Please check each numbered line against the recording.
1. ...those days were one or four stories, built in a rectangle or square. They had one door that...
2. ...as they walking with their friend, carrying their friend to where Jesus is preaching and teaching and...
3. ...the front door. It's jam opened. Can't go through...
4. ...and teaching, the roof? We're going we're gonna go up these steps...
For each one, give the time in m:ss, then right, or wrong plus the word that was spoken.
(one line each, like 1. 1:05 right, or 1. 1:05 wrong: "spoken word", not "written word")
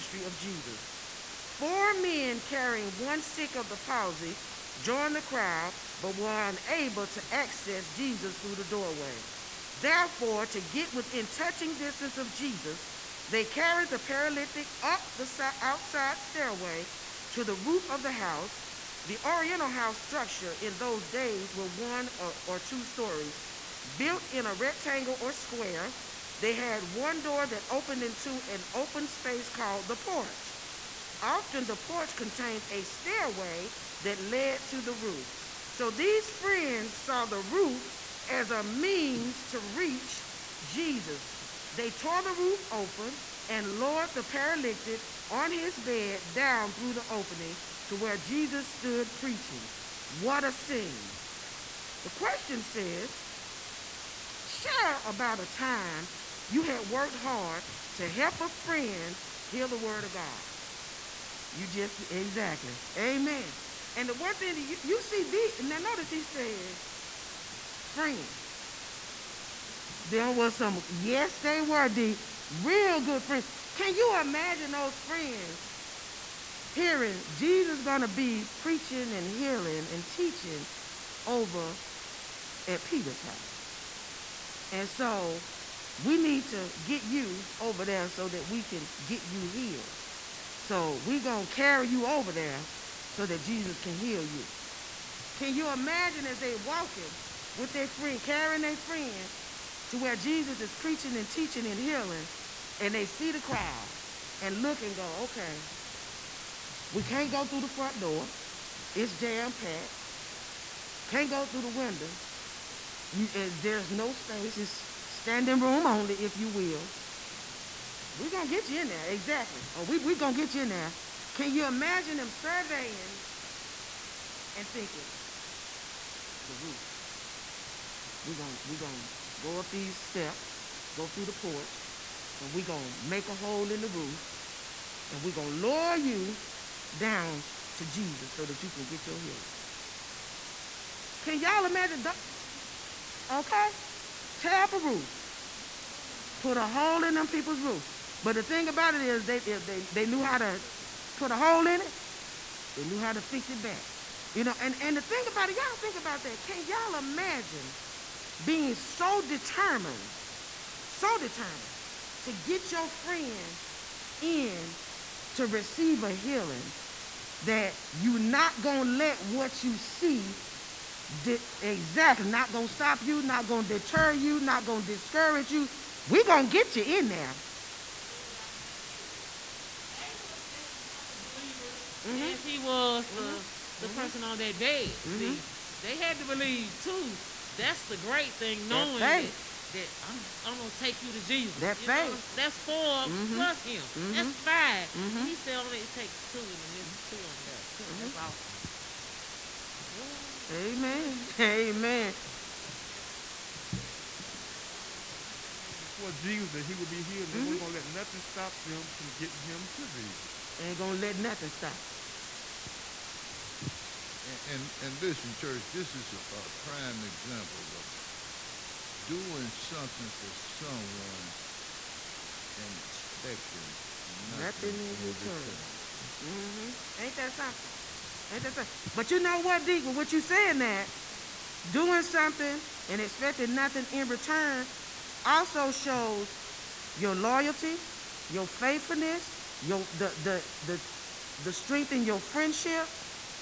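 1. 0:20 wrong: "two", not "four"
2. 1:36 right
3. 1:47 wrong: "packed", not "opened"
4. 2:04 wrong: "thinking", not "teaching".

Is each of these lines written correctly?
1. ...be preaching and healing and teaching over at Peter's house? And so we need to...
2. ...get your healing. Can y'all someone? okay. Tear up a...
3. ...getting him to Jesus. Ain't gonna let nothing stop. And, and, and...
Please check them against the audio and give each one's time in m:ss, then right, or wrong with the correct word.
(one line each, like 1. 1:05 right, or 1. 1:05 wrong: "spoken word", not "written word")
1. 1:18 right
2. 2:18 wrong: "imagine", not "someone"
3. 3:29 right.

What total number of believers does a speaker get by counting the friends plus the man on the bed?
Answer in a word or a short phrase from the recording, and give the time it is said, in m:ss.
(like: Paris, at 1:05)
5, at 3:14.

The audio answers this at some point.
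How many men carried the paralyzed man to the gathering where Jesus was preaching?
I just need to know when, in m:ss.
0:01.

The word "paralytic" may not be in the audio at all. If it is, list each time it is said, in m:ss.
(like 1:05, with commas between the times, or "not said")
0:13, 0:44.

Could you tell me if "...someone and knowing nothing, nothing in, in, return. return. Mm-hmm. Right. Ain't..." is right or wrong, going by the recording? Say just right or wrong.
wrong.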